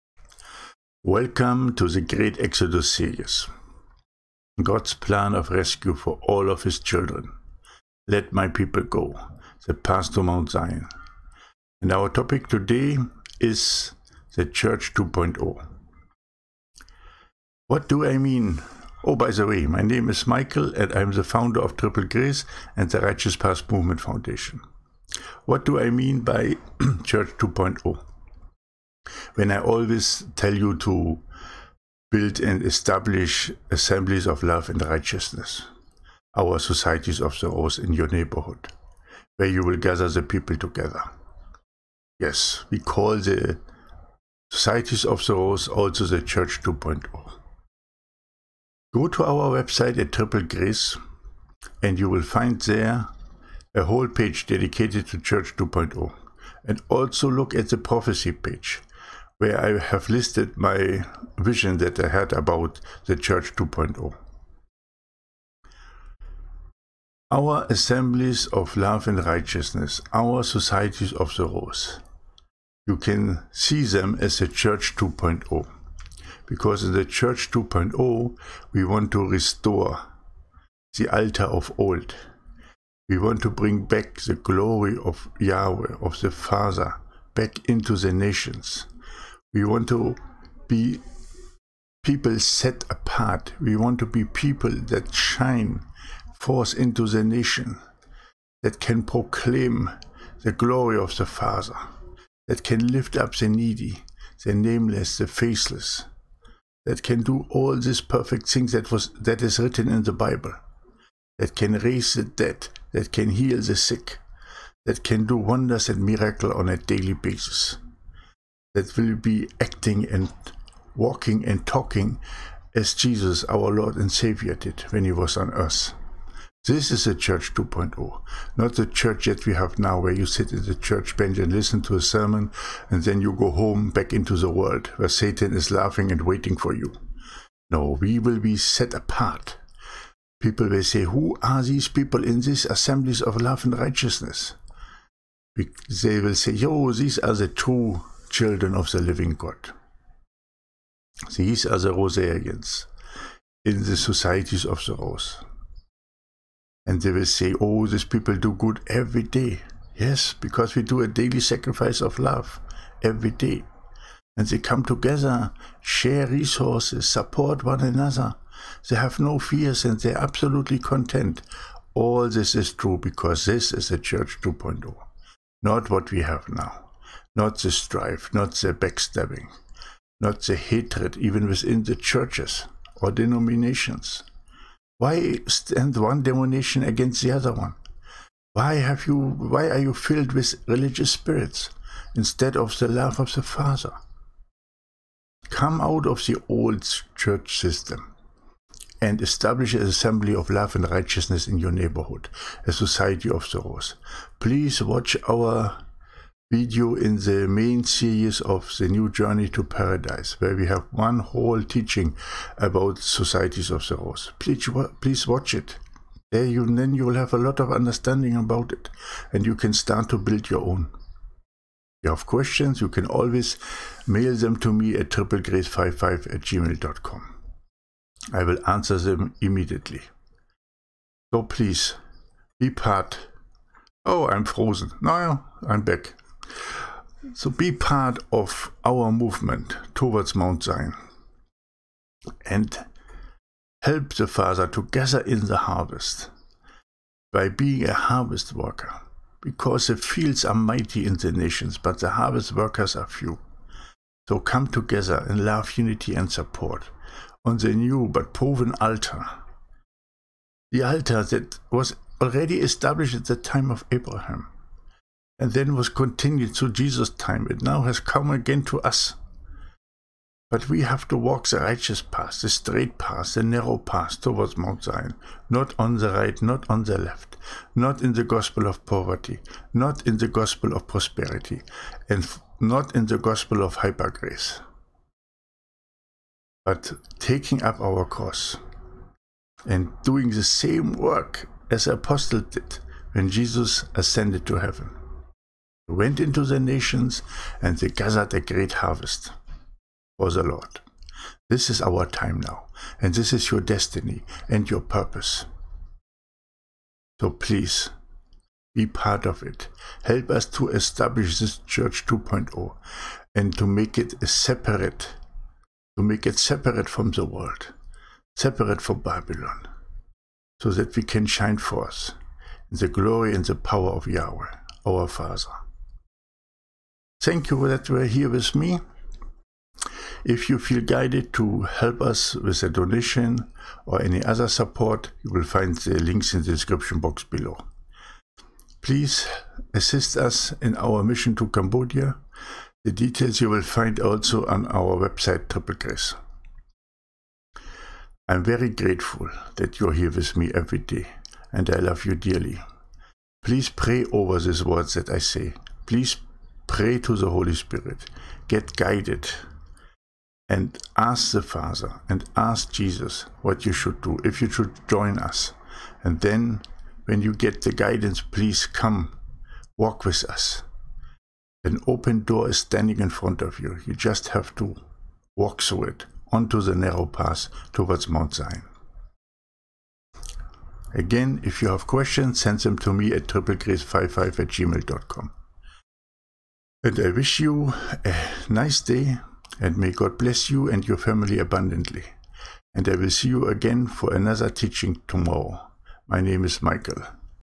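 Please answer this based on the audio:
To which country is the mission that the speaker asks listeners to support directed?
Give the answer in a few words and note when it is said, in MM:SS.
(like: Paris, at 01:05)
Cambodia, at 05:41.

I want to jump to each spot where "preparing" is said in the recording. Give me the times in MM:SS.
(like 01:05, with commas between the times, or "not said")
not said.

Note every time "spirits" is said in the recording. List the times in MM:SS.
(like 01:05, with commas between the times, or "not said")
03:11, 05:57.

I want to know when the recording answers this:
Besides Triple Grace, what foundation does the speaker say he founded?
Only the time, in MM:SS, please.
00:23.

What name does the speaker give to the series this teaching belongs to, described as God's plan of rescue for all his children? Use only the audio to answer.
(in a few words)
Great Exodus.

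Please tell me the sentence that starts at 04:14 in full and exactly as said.
So come together in love, unity, and support on the new but proven altar.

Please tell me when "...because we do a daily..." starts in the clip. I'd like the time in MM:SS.
02:40.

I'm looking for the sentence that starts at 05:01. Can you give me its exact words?
This is our time now, and this is your destiny and your purpose.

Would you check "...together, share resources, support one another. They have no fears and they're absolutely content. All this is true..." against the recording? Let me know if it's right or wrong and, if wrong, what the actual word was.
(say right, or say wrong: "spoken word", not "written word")
right.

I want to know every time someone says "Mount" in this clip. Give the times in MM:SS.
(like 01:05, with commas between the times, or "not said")
00:10, 04:00, 04:34, 06:18.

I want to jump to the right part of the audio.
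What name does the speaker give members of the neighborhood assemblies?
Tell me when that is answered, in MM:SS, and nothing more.
02:31.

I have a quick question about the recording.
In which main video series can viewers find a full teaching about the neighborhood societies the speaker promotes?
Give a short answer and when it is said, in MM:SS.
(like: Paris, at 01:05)
New Journey to Paradise, at 03:28.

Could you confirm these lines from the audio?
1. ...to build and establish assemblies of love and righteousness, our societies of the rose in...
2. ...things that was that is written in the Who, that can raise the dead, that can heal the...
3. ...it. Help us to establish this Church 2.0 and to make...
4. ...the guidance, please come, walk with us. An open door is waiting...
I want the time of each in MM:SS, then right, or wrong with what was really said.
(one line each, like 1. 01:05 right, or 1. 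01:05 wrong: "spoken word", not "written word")
1. 00:30 right
2. 01:48 wrong: "Bible", not "Who"
3. 05:09 right
4. 06:07 wrong: "standing", not "waiting".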